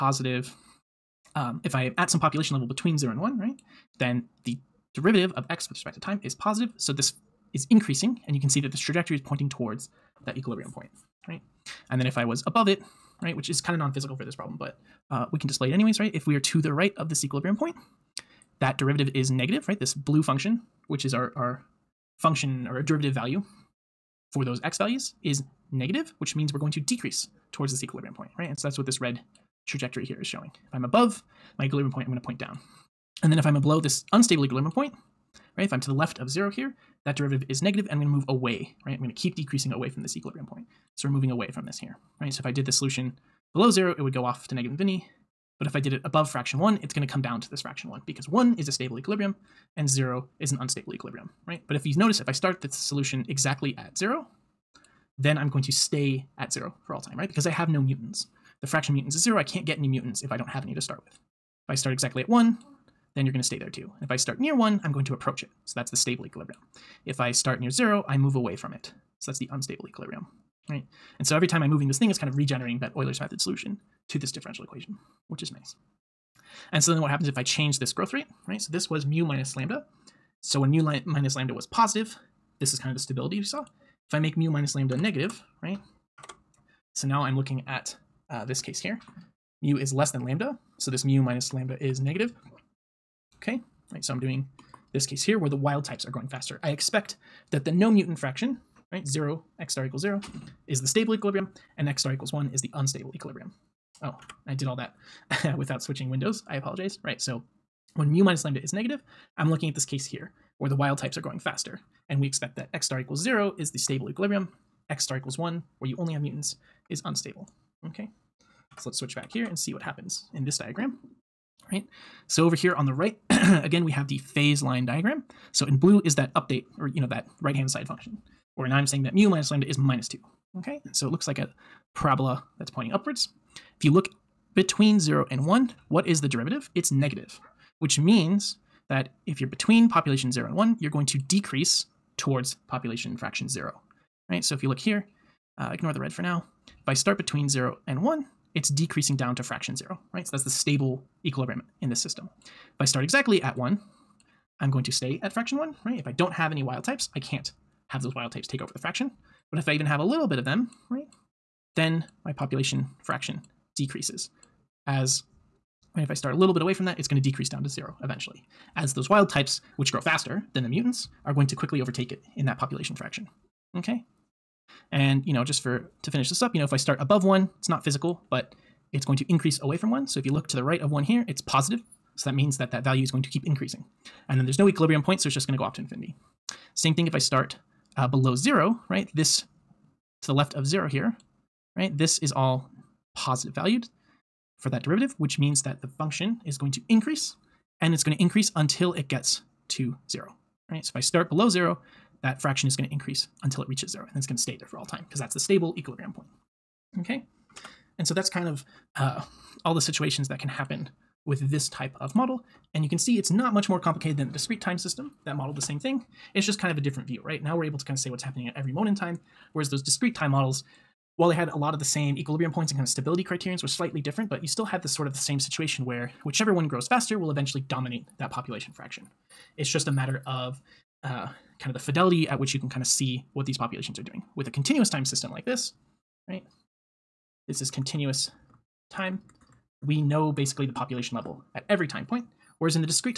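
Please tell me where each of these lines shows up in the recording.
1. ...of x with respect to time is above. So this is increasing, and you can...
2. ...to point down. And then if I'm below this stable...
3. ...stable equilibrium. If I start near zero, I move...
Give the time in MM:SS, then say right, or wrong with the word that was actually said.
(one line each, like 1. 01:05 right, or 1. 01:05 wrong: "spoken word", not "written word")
1. 00:05 wrong: "positive", not "above"
2. 00:32 wrong: "unstable", not "stable"
3. 01:05 right.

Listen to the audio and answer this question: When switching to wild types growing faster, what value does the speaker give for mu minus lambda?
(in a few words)
-2.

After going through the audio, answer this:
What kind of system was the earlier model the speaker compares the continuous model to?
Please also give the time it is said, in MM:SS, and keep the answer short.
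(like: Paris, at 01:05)
Discrete time system, at 03:34.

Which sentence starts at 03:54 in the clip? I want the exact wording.
With a continuous time system like this, right?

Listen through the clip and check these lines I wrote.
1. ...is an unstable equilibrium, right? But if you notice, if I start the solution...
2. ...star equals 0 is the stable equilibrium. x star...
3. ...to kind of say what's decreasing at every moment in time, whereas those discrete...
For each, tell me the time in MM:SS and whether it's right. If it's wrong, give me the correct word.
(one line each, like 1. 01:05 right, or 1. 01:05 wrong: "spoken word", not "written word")
1. 00:50 right
2. 01:52 right
3. 03:37 wrong: "happening", not "decreasing".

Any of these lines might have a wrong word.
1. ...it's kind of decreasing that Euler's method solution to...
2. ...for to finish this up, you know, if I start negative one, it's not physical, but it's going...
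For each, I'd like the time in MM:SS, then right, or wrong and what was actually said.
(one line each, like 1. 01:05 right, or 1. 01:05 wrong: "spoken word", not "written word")
1. 01:12 wrong: "regenerating", not "decreasing"
2. 02:55 wrong: "above", not "negative".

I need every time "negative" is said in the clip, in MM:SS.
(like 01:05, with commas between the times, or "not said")
00:19, 00:25, 00:37, 00:44, 01:24, 01:31, 01:48, 02:16.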